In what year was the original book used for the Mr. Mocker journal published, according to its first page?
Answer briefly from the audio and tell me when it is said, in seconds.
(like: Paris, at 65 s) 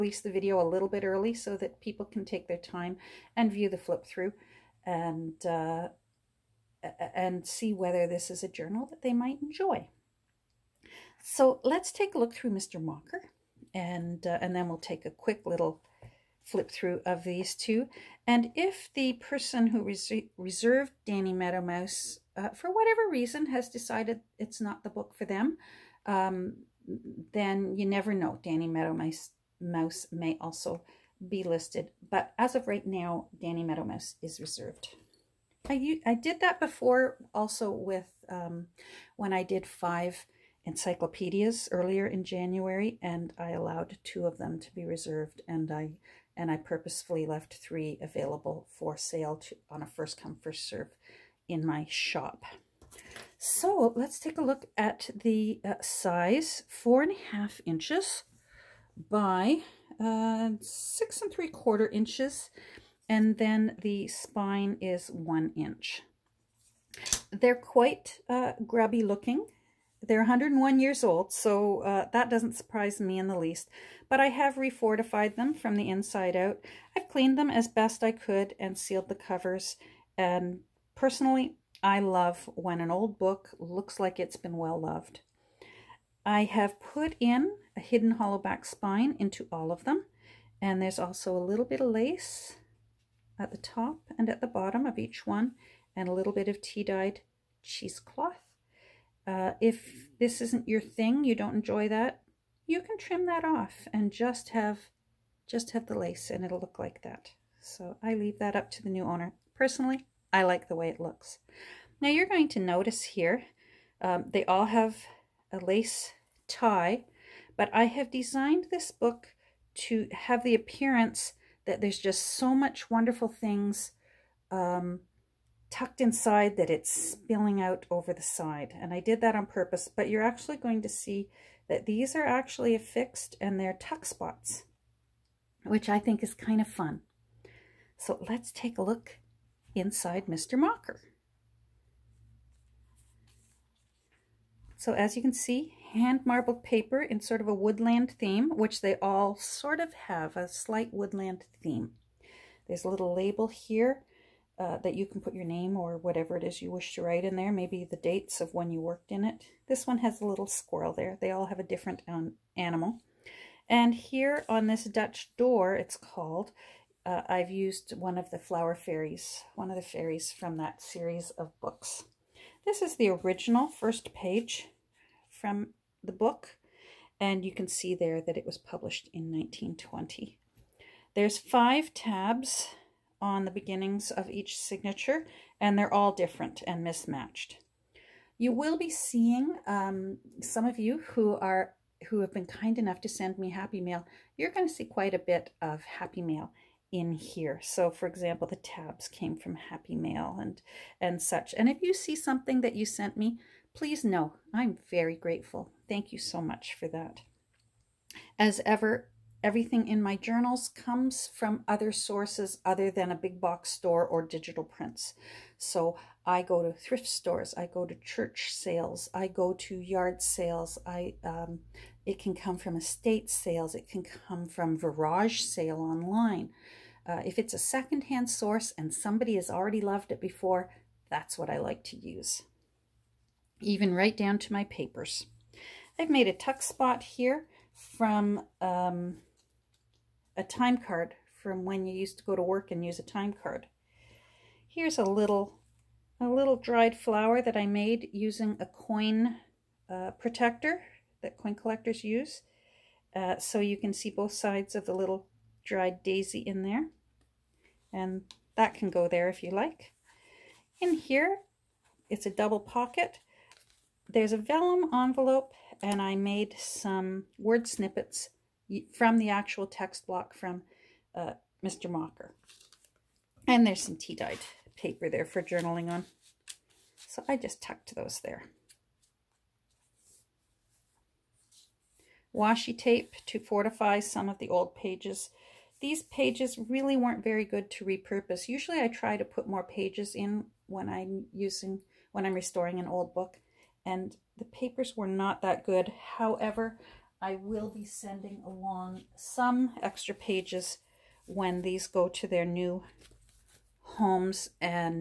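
1920, at 179 s.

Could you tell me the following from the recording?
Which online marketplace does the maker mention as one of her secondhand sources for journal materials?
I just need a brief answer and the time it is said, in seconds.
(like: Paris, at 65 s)
VarageSale, at 224 s.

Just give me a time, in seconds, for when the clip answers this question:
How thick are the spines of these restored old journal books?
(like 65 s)
65 s.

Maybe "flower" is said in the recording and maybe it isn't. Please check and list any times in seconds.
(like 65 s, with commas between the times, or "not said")
168 s, 246 s.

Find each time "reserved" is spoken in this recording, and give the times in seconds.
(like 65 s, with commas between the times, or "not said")
20 s, 34 s, 44 s.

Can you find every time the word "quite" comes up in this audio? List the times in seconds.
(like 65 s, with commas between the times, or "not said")
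67 s, 194 s.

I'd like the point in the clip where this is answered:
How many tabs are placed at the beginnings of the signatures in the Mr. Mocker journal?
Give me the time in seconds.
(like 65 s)
181 s.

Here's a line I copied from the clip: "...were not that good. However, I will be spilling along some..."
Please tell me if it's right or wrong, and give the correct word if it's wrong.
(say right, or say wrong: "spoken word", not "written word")
wrong: "sending", not "spilling".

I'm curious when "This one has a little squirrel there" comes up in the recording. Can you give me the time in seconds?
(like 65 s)
159 s.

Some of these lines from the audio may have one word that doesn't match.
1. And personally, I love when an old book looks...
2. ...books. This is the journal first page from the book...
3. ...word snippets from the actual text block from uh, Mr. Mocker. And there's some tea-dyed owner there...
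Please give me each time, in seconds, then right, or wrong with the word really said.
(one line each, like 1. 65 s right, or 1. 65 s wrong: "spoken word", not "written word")
1. 80 s right
2. 171 s wrong: "original", not "journal"
3. 267 s wrong: "paper", not "owner".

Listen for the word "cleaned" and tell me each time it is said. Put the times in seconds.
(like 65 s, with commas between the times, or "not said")
77 s.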